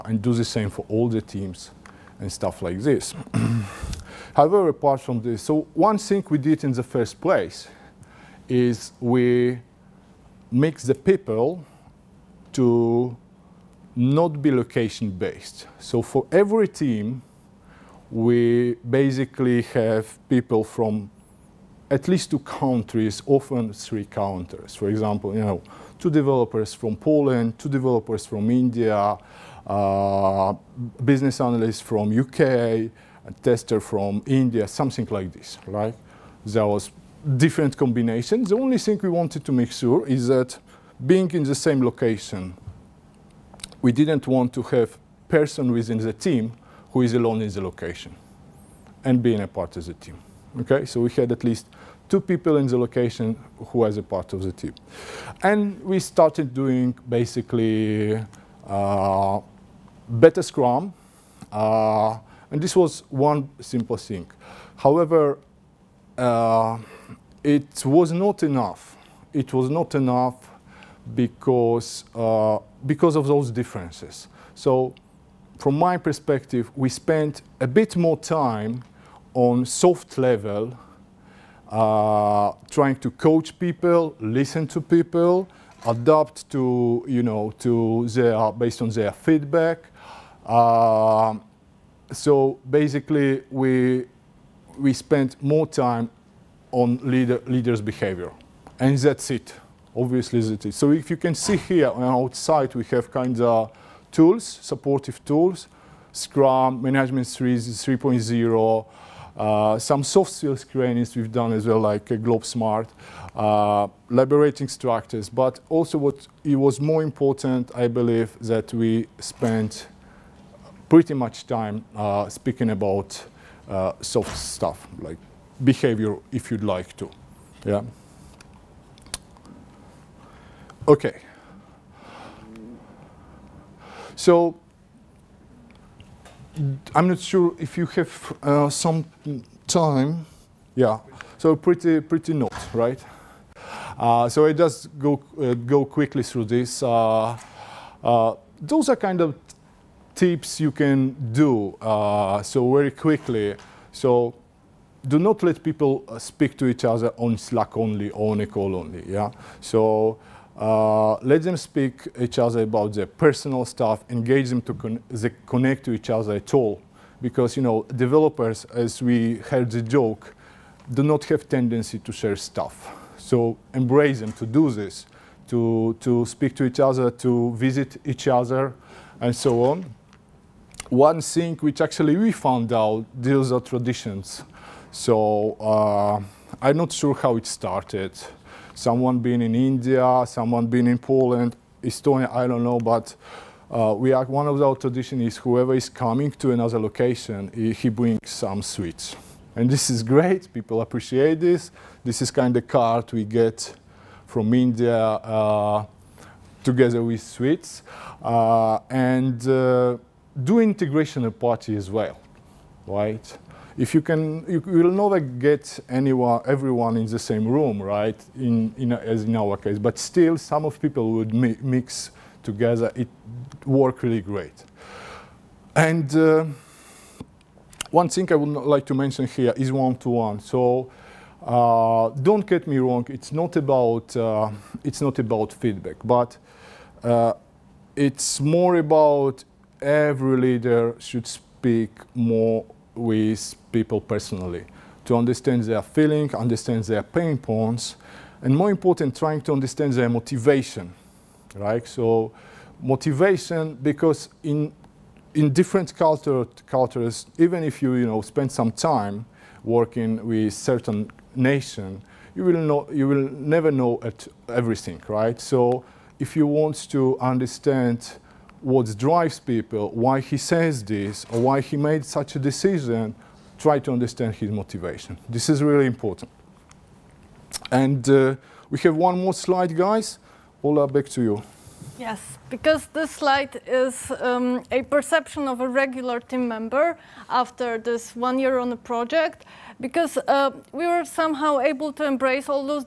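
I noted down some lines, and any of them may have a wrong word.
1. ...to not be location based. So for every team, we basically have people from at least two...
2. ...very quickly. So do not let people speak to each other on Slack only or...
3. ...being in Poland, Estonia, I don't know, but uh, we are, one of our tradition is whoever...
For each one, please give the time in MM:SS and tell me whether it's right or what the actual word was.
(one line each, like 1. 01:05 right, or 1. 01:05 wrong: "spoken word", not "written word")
1. 00:12 right
2. 02:32 right
3. 03:10 right.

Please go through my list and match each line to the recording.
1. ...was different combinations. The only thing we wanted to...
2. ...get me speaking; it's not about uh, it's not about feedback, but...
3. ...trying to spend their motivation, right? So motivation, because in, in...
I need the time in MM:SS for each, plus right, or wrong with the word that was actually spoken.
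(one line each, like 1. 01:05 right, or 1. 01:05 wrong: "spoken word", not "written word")
1. 00:36 right
2. 03:52 wrong: "wrong", not "speaking"
3. 04:09 wrong: "understand", not "spend".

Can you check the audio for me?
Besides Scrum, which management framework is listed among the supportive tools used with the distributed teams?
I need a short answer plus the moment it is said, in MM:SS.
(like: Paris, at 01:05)
Management 3.0, at 01:46.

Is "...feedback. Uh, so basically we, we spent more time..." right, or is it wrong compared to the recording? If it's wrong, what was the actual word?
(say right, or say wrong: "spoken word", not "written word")
right.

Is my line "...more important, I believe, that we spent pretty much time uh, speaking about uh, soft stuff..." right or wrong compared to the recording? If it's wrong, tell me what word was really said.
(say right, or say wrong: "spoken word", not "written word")
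right.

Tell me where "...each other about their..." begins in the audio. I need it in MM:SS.
02:42.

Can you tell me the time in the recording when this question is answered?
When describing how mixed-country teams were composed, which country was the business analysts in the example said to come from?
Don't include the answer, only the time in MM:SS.
00:32.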